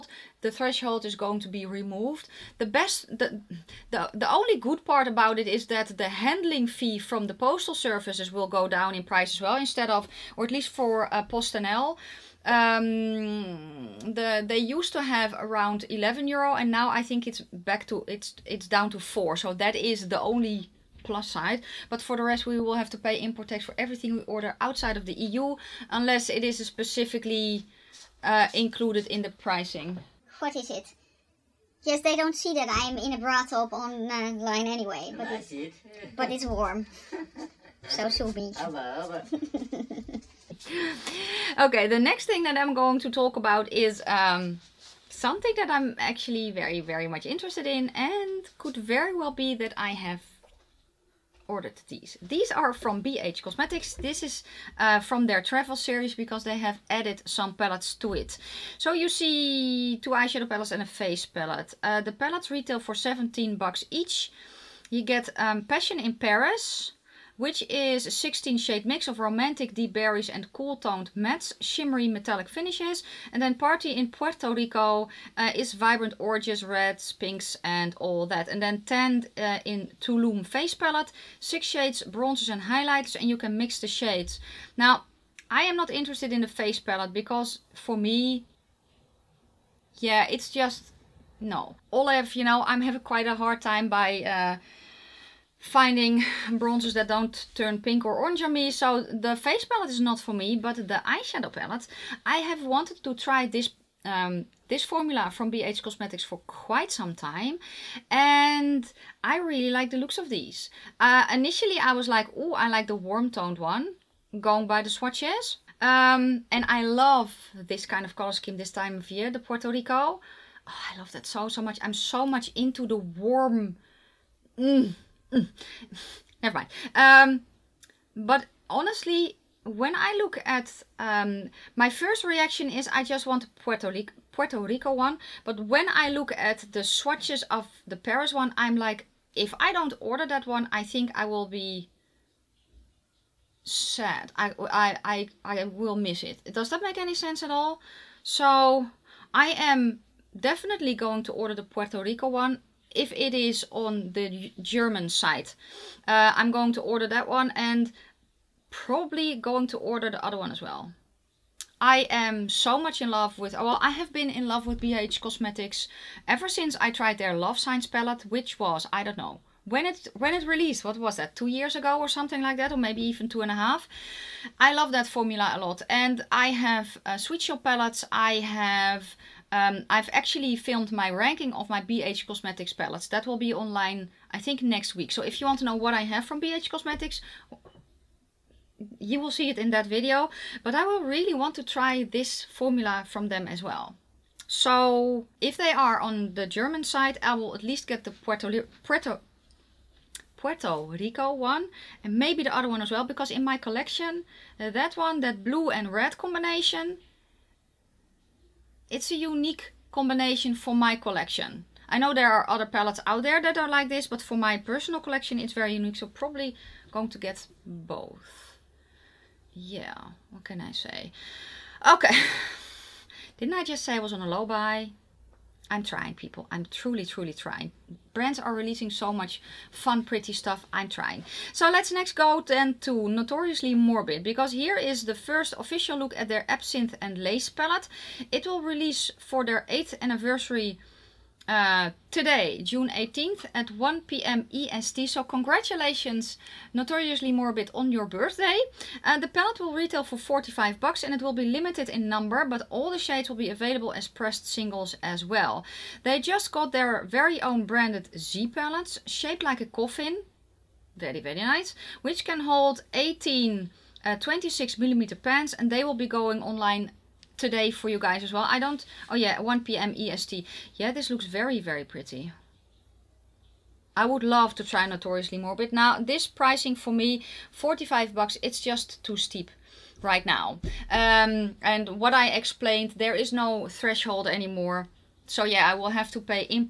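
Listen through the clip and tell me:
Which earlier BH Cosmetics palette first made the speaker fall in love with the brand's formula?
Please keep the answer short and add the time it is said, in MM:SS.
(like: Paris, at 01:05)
Love Signs, at 02:47.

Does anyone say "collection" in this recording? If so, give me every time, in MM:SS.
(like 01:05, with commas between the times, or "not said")
03:23, 03:30, 03:34.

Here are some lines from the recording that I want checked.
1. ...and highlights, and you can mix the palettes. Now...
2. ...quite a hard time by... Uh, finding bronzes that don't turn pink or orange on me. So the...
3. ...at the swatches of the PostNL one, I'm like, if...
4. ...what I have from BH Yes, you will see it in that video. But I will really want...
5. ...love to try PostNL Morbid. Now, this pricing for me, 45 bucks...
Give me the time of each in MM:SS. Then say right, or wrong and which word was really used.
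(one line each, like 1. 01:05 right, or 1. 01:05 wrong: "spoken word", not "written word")
1. 01:22 wrong: "shades", not "palettes"
2. 01:33 right
3. 02:16 wrong: "Paris", not "PostNL"
4. 03:05 wrong: "Cosmetics", not "Yes"
5. 04:34 wrong: "Notoriously", not "PostNL".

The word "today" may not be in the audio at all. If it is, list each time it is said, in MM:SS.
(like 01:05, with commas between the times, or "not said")
04:02, 04:27.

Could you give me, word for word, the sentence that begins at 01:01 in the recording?
Uh, the palettes retail for 17 bucks each.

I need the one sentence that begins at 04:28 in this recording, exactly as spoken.
I don't, oh yeah, 1 p.m.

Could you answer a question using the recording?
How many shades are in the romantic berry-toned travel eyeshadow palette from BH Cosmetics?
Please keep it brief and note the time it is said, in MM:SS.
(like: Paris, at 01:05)
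16, at 01:08.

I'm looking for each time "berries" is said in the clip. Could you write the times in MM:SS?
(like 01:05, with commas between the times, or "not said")
01:09.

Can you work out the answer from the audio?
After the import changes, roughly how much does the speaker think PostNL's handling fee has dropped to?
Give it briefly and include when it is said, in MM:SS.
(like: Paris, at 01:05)
4 euro, at 00:18.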